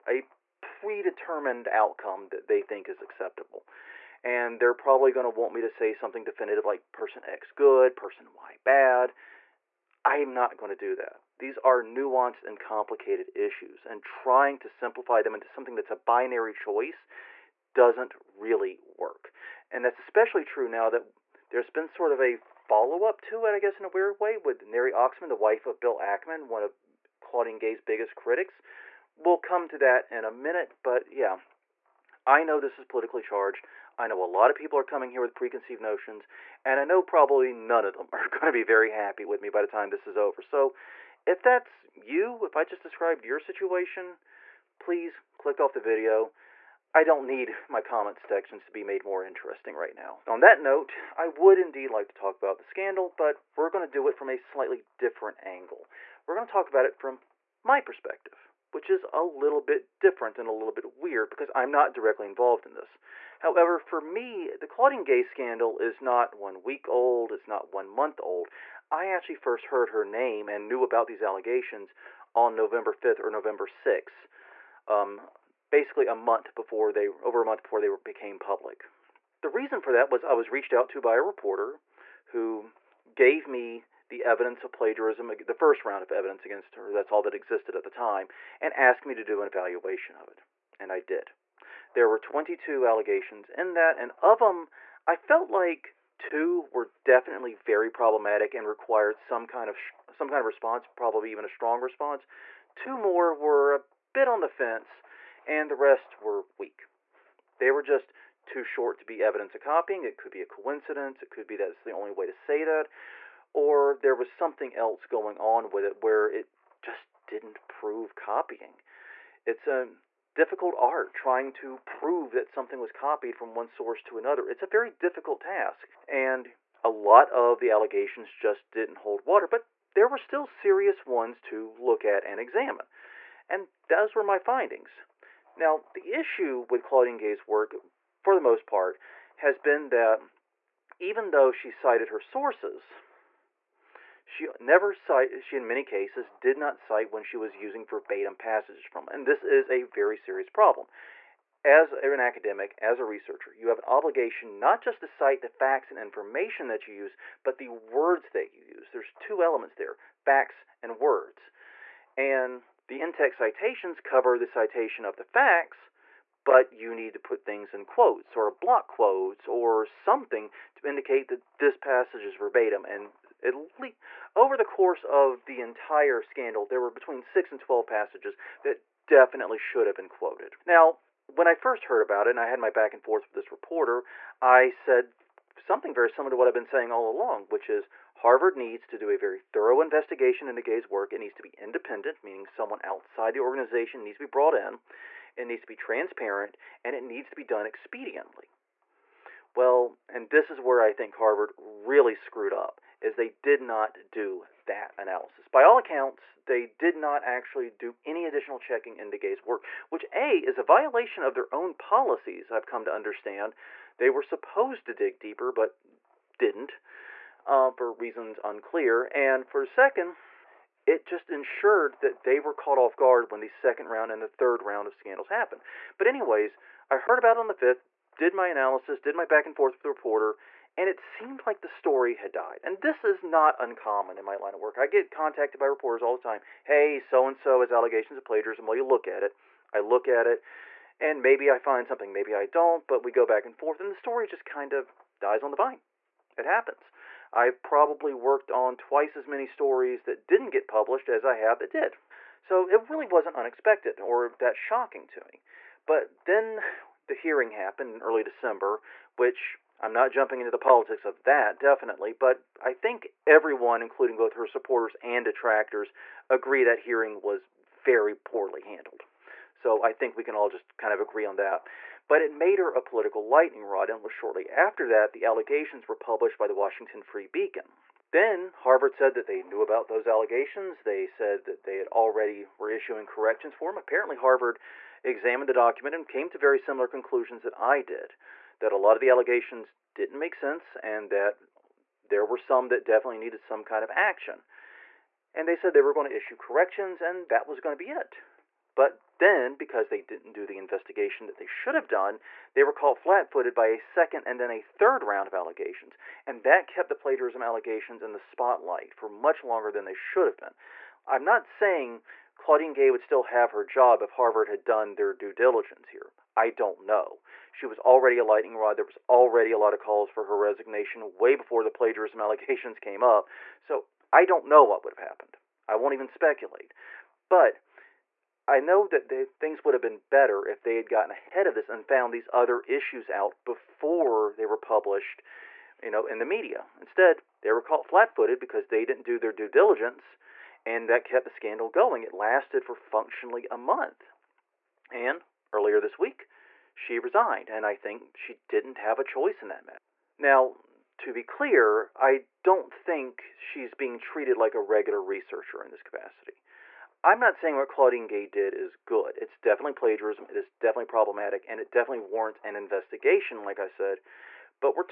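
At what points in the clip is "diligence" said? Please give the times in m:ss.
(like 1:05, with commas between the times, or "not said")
5:15, 5:39.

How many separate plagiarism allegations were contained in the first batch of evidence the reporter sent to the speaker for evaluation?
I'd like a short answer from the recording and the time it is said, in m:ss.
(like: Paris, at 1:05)
22, at 1:32.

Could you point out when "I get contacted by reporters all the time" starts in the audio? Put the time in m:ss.
3:54.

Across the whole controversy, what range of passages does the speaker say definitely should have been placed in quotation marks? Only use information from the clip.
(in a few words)
6 to 12.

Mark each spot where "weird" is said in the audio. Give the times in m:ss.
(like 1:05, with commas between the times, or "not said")
0:23, 1:00.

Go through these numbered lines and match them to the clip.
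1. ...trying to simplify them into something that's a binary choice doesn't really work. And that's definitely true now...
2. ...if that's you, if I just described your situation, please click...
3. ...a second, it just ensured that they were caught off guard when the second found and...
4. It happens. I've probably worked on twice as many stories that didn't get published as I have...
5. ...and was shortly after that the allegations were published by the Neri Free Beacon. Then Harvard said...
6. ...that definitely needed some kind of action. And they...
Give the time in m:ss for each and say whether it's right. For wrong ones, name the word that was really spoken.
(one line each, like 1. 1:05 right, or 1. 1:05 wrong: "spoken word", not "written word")
1. 0:14 wrong: "especially", not "definitely"
2. 0:41 right
3. 3:39 wrong: "round", not "found"
4. 4:06 right
5. 4:33 wrong: "Washington", not "Neri"
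6. 4:52 right.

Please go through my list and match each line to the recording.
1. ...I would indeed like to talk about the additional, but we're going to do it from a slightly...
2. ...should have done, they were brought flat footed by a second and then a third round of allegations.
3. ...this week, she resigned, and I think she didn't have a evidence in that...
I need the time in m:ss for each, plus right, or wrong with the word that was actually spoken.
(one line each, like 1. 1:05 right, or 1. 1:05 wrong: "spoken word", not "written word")
1. 0:51 wrong: "scandal", not "additional"
2. 5:01 wrong: "caught", not "brought"
3. 5:45 wrong: "choice", not "evidence".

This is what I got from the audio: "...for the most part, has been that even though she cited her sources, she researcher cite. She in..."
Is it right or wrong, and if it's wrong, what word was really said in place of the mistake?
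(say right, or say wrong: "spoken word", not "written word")
wrong: "never", not "researcher".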